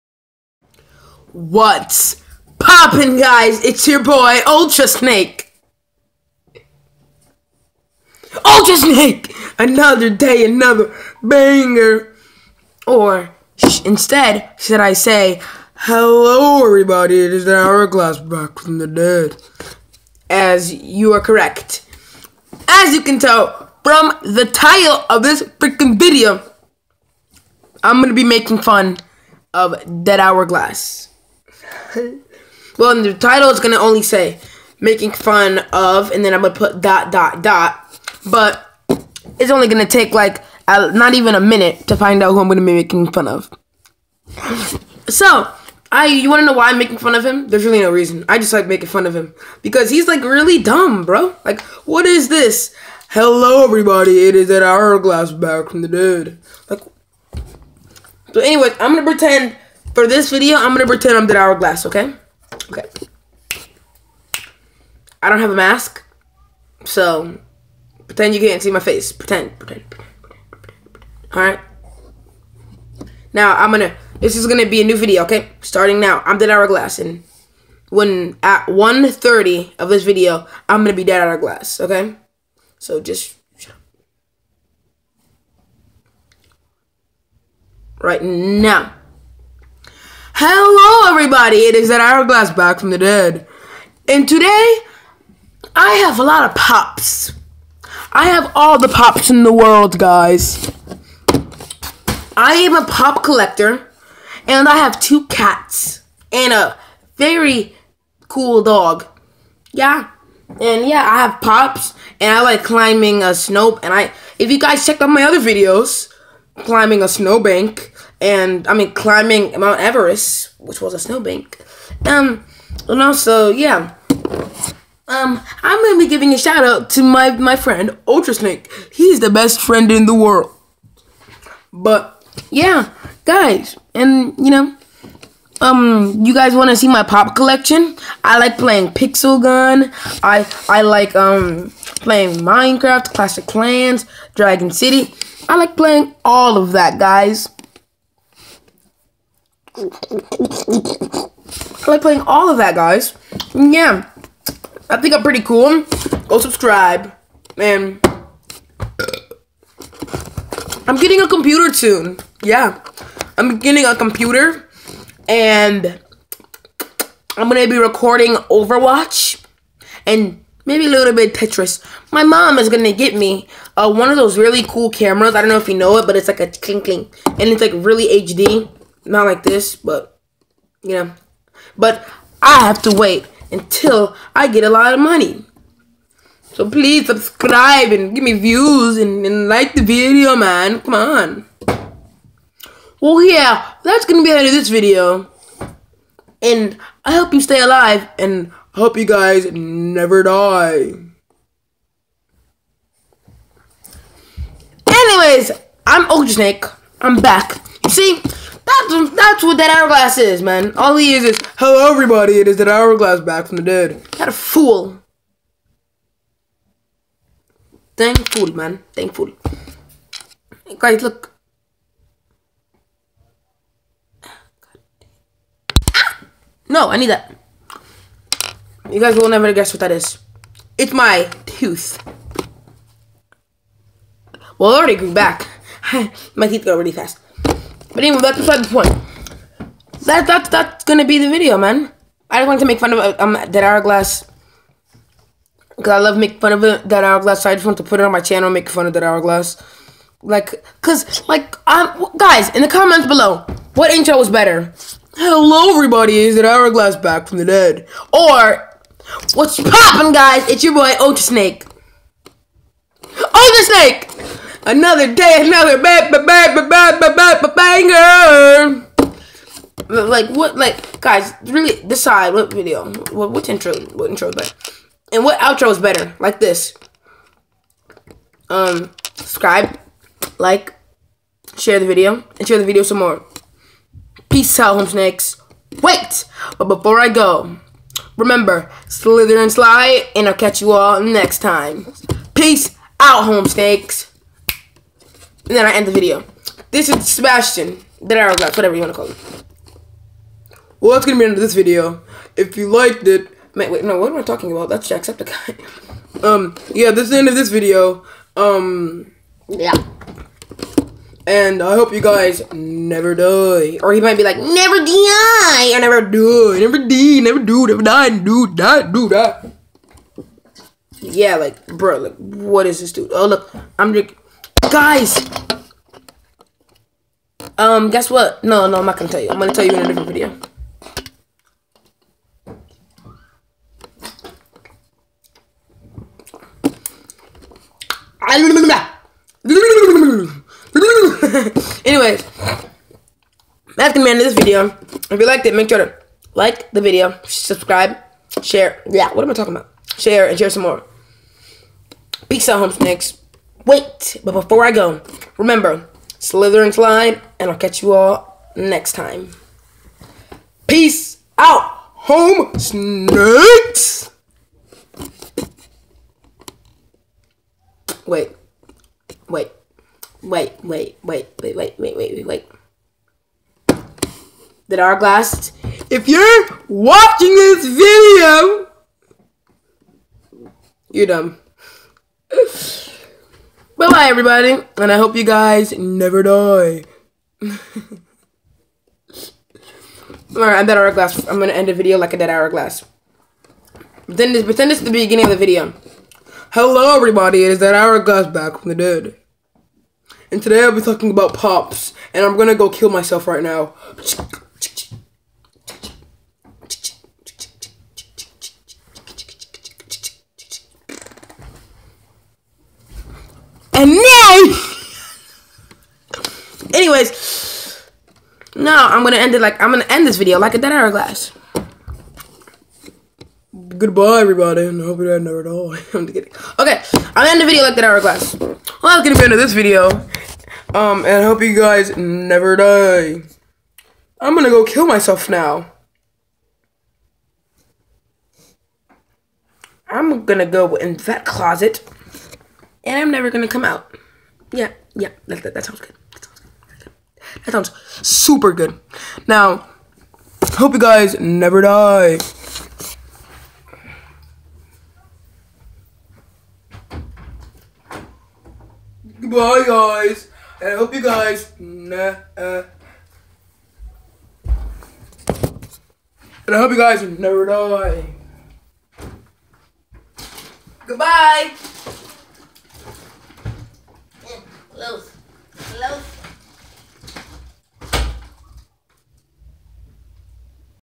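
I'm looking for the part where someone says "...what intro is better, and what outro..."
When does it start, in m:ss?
4:33.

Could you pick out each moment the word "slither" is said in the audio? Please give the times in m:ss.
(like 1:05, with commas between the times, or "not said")
4:48, 5:56.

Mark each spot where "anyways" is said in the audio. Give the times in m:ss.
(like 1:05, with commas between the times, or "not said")
0:58, 3:24, 3:58, 5:41, 6:56.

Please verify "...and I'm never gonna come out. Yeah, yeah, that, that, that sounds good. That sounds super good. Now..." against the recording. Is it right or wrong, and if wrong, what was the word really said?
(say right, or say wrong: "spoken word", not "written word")
right.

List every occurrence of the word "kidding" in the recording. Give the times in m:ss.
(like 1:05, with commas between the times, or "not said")
7:06.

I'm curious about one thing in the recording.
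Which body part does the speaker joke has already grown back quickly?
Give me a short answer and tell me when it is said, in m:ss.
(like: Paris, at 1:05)
Tooth, at 3:51.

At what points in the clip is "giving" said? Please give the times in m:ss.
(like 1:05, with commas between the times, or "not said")
2:06.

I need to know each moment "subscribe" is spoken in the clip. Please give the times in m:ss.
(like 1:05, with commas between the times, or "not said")
2:36, 3:07, 4:39, 5:47.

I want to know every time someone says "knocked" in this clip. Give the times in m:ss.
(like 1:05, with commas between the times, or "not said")
not said.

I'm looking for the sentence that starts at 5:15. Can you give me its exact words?
I never die, never die, never do, never die, do, die, do, die.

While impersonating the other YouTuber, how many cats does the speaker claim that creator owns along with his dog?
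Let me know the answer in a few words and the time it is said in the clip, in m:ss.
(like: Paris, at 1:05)
2, at 1:44.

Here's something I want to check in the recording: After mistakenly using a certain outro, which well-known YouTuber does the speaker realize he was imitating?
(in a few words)
Jacksepticeye.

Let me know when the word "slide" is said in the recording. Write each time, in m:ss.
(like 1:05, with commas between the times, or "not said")
4:49, 5:56.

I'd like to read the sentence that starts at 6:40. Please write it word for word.
And today I'll be talking about pops, and I'm gonna go kill myself right now.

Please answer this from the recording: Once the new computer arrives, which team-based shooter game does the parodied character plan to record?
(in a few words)
Overwatch.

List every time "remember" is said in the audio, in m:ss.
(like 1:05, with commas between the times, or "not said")
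4:48, 5:55.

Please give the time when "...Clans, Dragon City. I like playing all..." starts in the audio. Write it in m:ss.
2:23.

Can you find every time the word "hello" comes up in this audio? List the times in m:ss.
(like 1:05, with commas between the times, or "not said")
0:15, 0:53, 1:30, 3:31, 4:15, 6:36.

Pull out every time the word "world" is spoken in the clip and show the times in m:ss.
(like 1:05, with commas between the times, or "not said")
1:39, 2:10.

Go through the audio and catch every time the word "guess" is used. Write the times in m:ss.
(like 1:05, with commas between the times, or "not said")
3:49, 5:27.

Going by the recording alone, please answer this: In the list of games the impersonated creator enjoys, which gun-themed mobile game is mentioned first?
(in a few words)
Pixel Gun.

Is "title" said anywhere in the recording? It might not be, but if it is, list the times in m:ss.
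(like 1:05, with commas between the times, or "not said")
0:24, 0:33.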